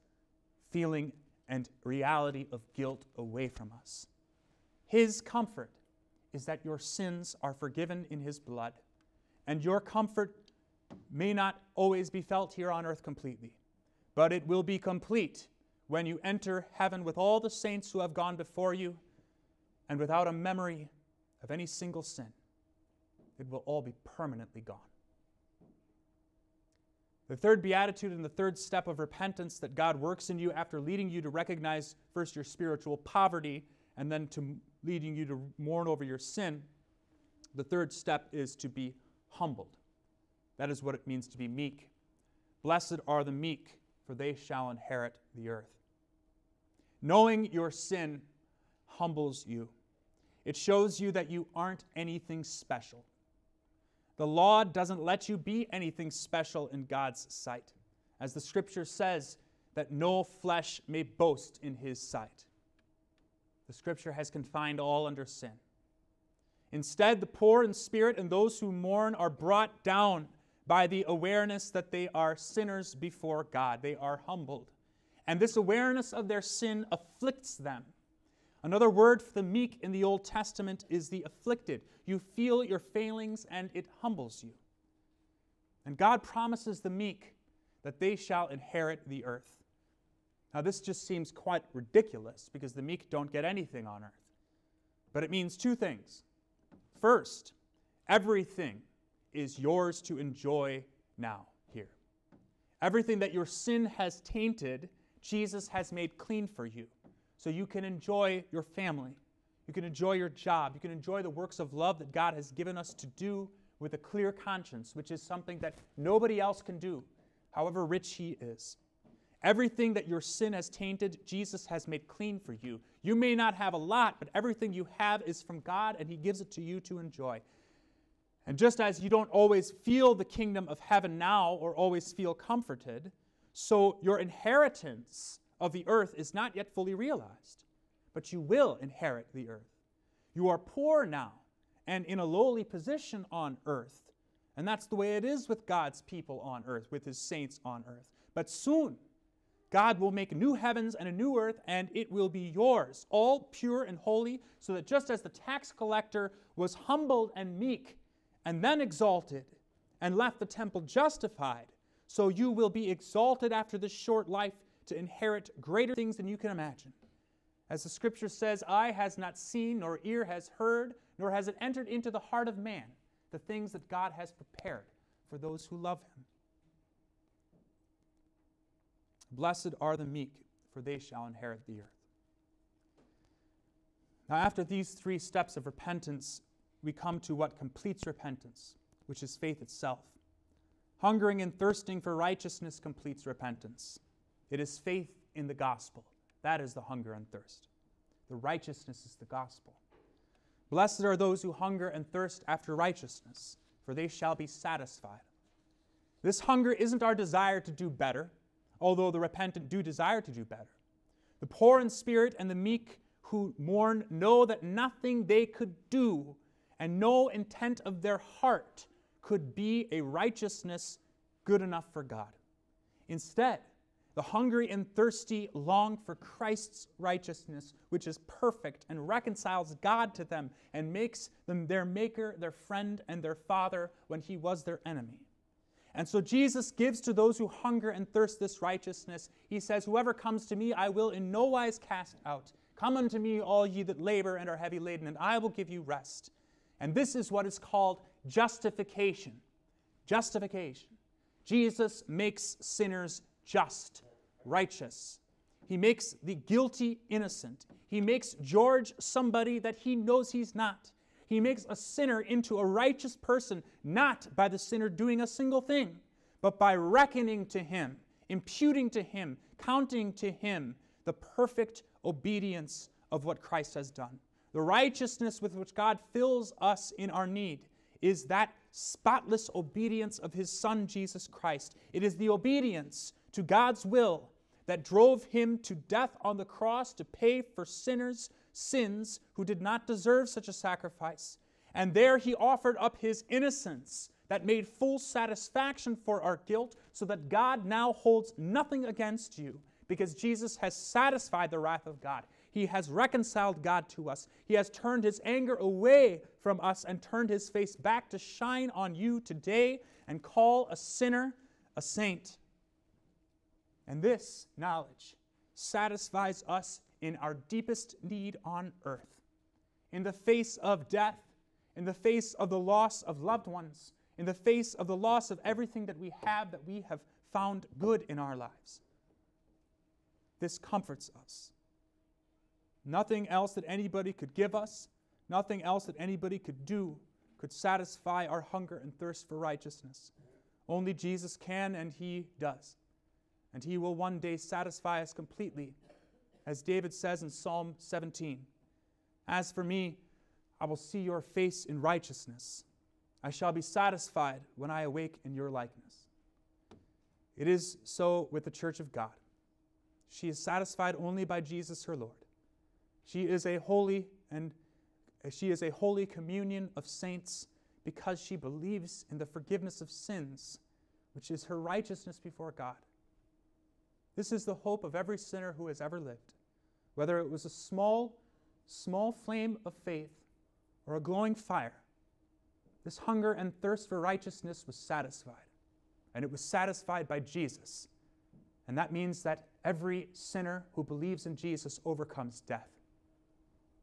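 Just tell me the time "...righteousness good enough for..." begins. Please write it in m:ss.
3:40.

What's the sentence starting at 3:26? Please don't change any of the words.
This hunger isn't our desire to do better, although the repentant do desire to do better.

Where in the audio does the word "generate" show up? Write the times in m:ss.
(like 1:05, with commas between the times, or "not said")
not said.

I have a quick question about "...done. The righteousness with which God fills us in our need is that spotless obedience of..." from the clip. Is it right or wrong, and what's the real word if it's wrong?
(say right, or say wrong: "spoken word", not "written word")
right.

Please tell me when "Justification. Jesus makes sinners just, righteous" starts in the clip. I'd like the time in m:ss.
4:10.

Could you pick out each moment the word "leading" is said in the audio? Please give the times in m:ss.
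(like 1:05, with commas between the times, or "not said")
0:30, 0:34.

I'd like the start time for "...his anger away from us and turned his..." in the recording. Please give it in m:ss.
5:05.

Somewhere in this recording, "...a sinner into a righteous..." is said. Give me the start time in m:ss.
4:21.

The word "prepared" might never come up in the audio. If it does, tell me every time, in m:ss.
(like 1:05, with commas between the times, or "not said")
2:54.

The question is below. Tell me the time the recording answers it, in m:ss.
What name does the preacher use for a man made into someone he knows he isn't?
4:18.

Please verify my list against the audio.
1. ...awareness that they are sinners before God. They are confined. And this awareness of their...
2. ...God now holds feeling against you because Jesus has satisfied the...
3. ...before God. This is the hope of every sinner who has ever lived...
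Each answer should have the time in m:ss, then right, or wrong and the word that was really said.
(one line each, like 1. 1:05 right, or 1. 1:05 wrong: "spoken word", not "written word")
1. 1:11 wrong: "humbled", not "confined"
2. 4:57 wrong: "nothing", not "feeling"
3. 6:12 right.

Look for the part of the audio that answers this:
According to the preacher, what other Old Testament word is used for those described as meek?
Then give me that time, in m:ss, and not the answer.
1:21.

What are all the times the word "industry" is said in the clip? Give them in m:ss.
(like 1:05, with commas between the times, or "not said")
not said.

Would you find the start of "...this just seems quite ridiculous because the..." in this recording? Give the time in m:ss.
1:30.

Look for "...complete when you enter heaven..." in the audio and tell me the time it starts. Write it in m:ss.
0:14.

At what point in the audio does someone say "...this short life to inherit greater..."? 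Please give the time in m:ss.
2:43.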